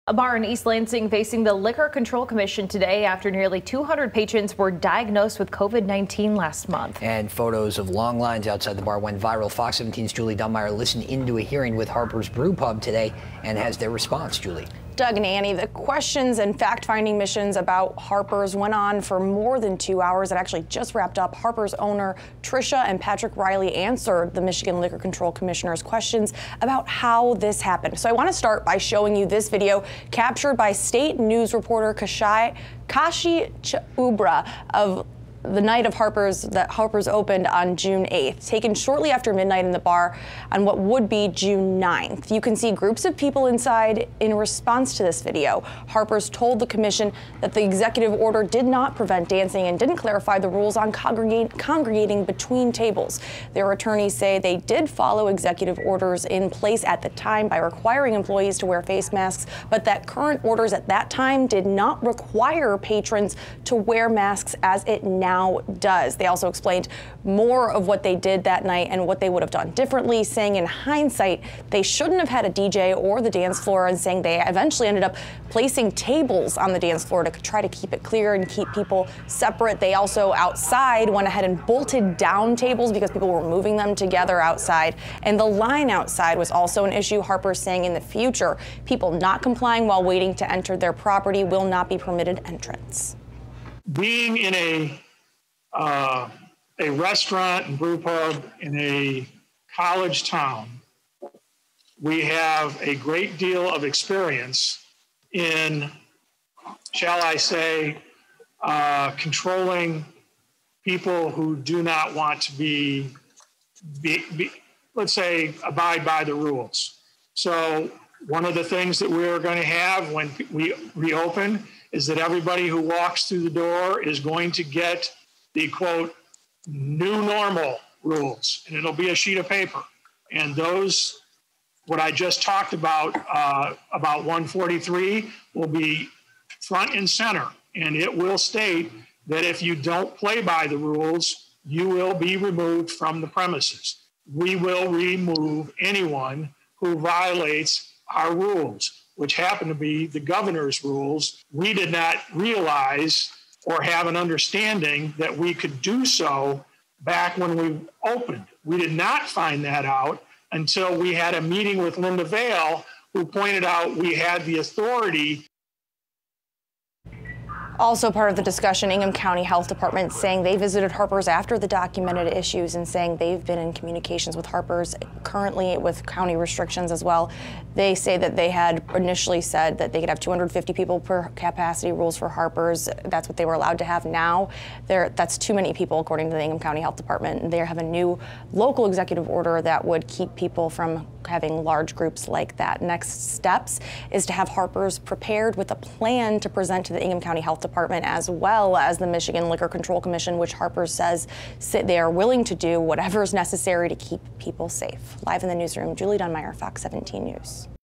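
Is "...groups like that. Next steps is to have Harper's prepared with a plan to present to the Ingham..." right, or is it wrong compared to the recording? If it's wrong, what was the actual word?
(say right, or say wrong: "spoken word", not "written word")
right.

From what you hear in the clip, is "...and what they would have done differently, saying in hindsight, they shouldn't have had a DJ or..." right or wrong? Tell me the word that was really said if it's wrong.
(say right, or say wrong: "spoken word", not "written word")
right.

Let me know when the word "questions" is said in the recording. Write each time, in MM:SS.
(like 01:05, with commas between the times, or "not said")
00:15, 00:25.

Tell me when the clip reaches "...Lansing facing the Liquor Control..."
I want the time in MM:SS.
00:00.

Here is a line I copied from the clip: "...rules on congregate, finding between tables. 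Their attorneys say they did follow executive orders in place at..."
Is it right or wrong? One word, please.
wrong.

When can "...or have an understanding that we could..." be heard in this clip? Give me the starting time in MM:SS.
02:33.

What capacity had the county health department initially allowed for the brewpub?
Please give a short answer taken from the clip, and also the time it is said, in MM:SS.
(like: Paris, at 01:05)
250 people, at 03:00.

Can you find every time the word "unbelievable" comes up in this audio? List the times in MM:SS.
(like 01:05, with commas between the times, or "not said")
not said.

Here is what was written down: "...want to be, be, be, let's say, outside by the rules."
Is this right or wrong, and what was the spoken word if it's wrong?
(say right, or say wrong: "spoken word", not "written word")
wrong: "abide", not "outside".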